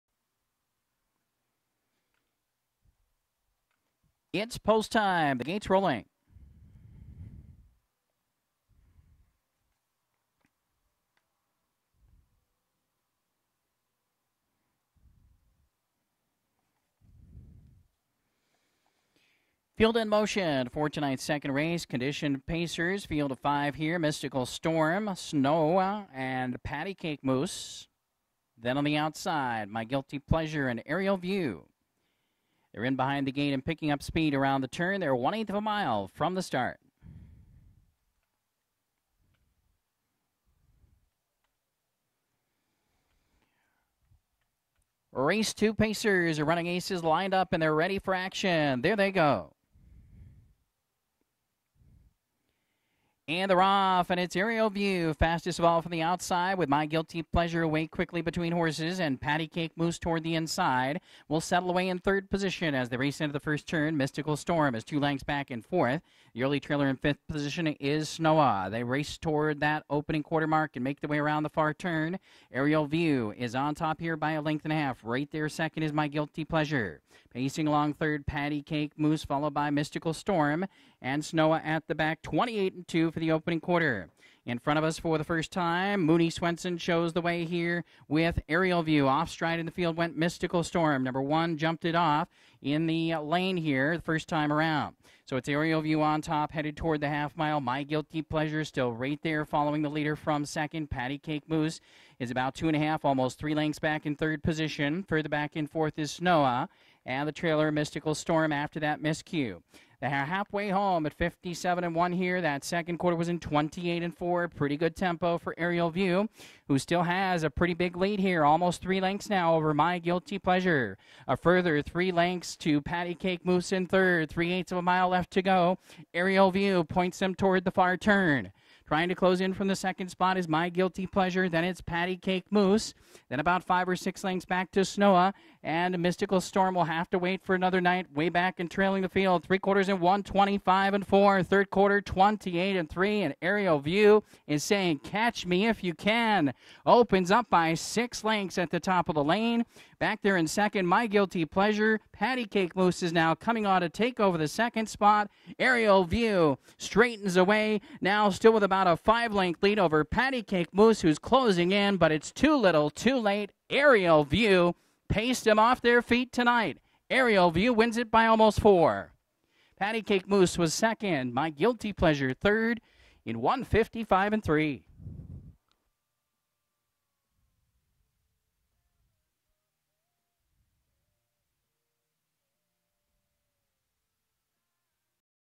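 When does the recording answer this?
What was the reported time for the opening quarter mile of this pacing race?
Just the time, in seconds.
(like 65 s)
82 s.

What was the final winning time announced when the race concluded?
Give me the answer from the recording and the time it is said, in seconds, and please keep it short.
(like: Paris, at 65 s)
1:55.3, at 173 s.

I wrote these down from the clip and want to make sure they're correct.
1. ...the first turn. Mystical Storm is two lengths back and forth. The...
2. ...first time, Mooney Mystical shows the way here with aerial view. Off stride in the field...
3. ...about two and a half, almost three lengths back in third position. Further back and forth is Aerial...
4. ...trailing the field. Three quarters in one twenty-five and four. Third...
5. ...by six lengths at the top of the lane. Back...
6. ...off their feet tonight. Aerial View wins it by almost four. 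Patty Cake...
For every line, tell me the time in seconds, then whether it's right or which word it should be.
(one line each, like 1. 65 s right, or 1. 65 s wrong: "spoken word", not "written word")
1. 63 s right
2. 85 s wrong: "Swenson", not "Mystical"
3. 102 s wrong: "Snowa", not "Aerial"
4. 138 s right
5. 147 s right
6. 165 s right.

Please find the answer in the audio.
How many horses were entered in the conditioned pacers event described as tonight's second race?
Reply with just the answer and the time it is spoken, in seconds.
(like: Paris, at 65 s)
5, at 23 s.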